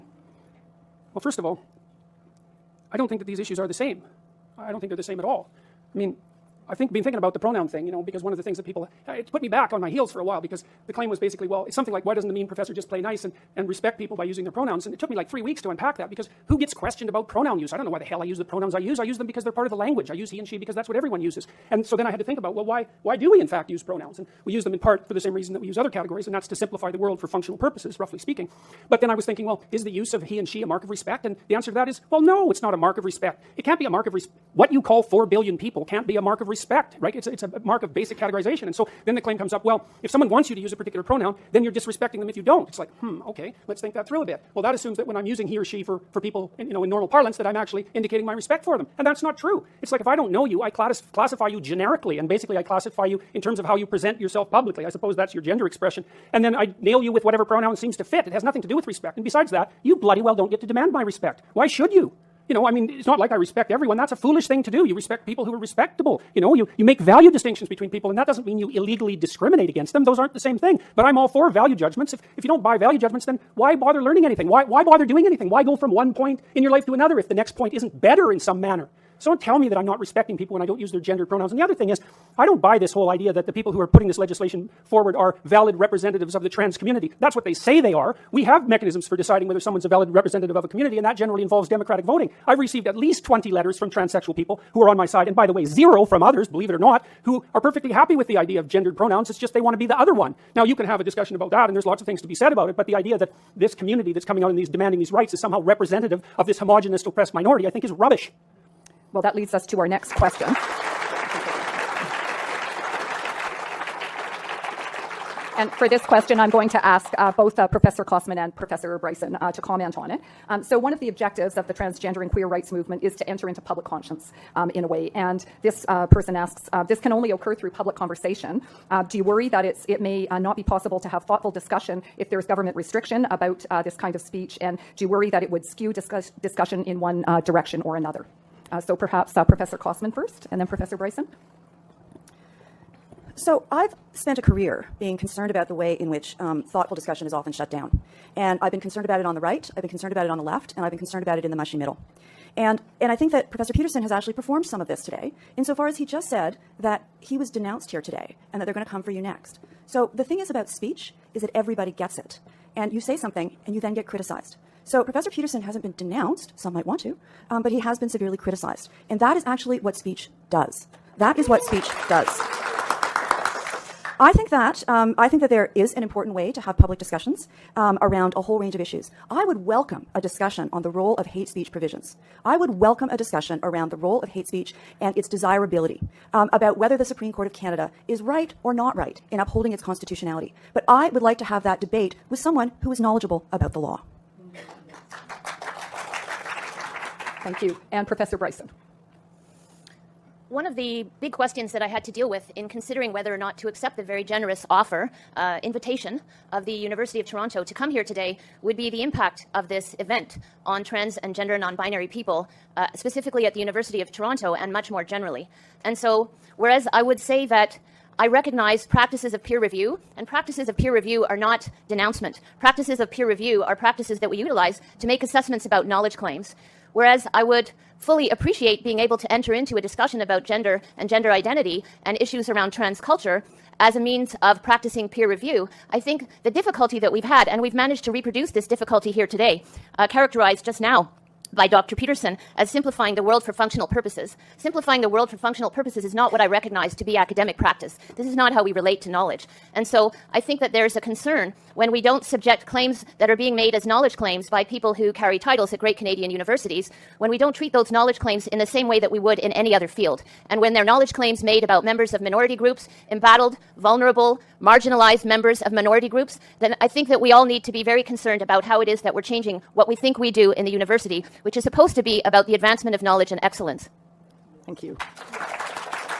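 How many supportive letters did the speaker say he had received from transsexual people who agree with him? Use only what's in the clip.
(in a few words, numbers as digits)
20.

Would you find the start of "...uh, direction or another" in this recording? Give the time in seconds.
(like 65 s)
137 s.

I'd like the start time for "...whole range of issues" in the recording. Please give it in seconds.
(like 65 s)
178 s.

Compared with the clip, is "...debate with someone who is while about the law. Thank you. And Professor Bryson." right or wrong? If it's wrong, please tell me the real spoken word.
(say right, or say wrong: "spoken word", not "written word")
wrong: "knowledgeable", not "while".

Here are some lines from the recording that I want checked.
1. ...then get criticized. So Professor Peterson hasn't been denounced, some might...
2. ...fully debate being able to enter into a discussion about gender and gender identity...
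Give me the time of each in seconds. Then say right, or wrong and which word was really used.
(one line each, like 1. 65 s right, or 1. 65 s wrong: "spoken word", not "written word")
1. 163 s right
2. 227 s wrong: "appreciate", not "debate".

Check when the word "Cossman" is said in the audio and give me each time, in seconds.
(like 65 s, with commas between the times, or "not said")
118 s, 139 s.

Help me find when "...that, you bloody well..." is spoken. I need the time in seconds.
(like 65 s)
59 s.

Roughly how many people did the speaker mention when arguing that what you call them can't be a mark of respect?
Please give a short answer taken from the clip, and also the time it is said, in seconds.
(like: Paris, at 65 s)
4 billion, at 35 s.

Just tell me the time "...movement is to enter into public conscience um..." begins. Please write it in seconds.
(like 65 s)
122 s.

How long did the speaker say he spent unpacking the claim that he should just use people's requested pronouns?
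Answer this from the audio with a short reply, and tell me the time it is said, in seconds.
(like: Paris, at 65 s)
3 weeks, at 15 s.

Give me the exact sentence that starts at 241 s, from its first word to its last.
Peterson as simplifying the world for functional purposes.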